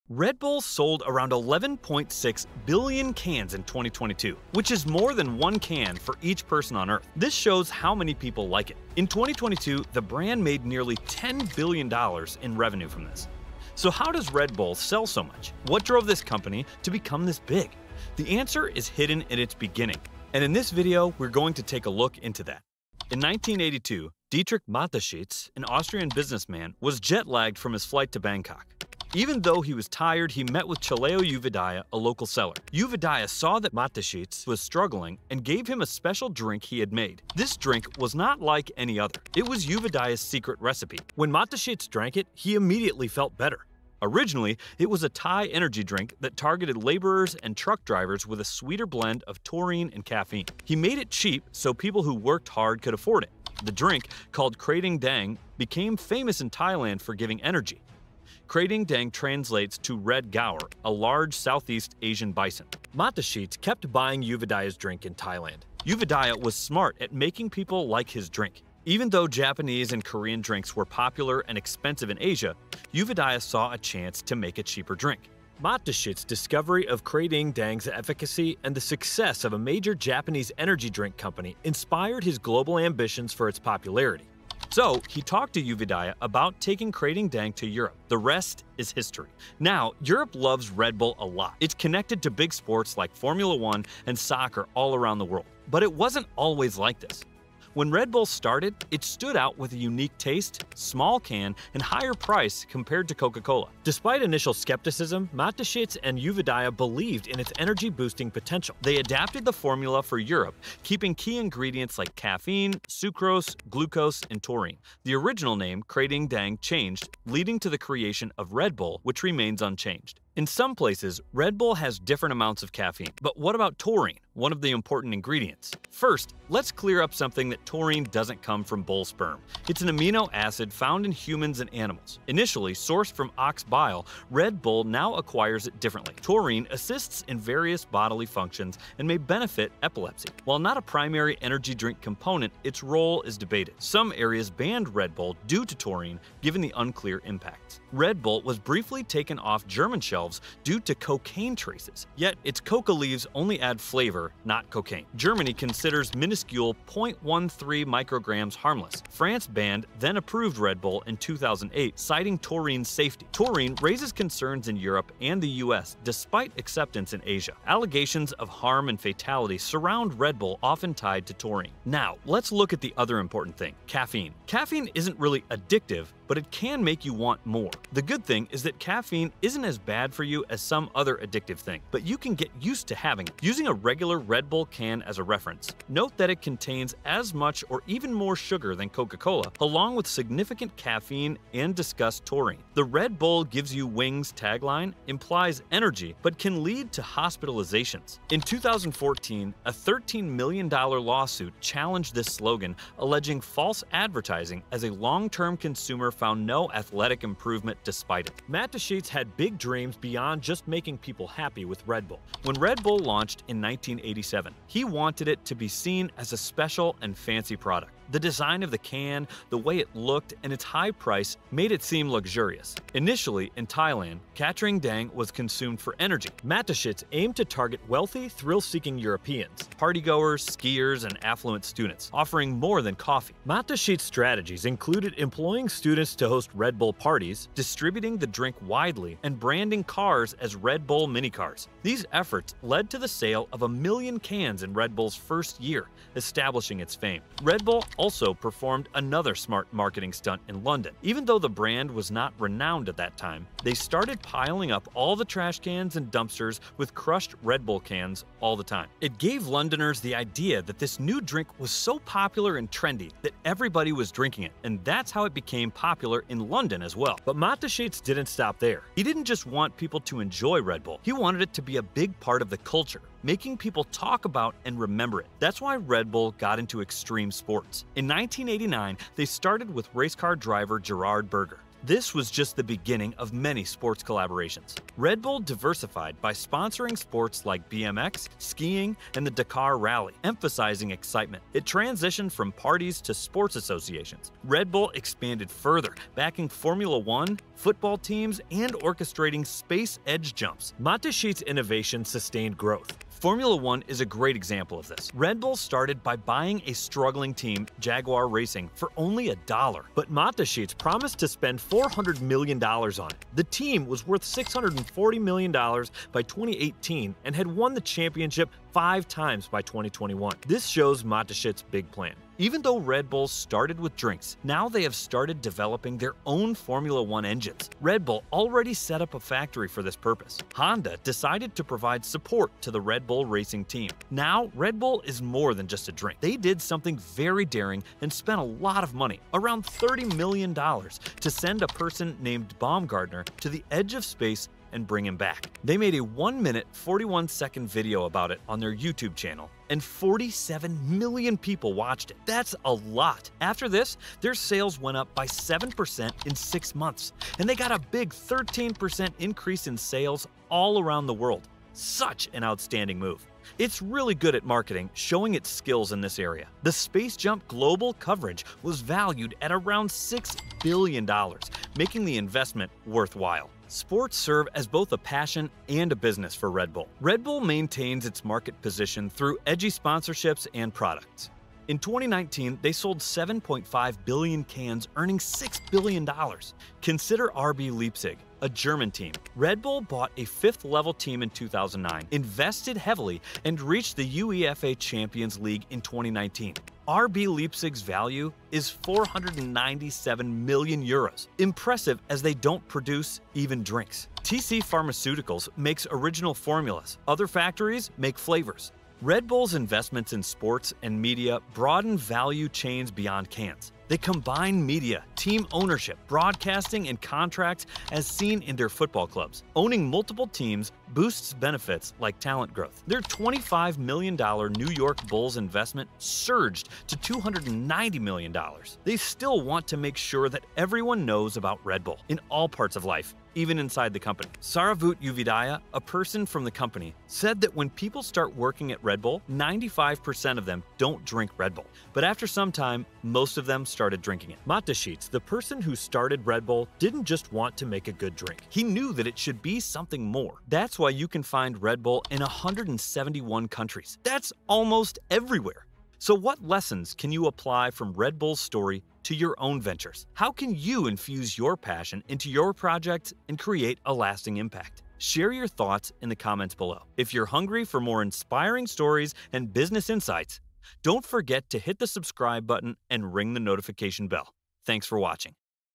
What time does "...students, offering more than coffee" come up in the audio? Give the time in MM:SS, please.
03:51.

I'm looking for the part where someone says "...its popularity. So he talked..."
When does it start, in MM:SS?
01:23.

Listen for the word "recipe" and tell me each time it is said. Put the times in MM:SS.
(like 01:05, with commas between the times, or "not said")
00:40.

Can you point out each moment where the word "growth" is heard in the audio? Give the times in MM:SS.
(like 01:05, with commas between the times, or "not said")
05:02, 07:02.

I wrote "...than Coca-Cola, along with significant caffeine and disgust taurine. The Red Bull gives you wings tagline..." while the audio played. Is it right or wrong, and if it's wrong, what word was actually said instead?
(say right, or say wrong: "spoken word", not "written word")
right.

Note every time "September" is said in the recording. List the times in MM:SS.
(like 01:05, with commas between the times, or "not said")
not said.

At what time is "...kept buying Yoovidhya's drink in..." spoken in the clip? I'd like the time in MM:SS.
01:03.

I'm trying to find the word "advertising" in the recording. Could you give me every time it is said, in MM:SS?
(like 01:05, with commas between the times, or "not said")
03:23.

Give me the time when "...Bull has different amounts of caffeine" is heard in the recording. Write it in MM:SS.
02:01.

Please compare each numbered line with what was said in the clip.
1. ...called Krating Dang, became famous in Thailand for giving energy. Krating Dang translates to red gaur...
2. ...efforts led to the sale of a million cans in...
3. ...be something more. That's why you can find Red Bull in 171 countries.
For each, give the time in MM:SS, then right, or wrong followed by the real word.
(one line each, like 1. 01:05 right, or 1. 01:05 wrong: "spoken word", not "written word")
1. 00:54 right
2. 04:02 right
3. 07:29 right.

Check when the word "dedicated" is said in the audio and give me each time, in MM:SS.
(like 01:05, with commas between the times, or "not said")
not said.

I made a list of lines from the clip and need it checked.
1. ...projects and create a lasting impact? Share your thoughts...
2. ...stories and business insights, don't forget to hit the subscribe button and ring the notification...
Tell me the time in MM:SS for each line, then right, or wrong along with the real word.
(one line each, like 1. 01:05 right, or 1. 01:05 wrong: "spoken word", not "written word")
1. 07:42 right
2. 07:48 right.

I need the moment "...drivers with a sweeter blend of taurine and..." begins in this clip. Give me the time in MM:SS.
00:47.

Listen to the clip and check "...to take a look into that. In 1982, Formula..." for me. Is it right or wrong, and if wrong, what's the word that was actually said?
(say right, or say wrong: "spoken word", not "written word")
wrong: "Dietrich", not "Formula".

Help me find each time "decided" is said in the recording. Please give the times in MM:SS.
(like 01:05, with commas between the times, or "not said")
05:31.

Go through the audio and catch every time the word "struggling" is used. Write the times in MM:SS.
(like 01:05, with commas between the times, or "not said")
00:34, 05:06.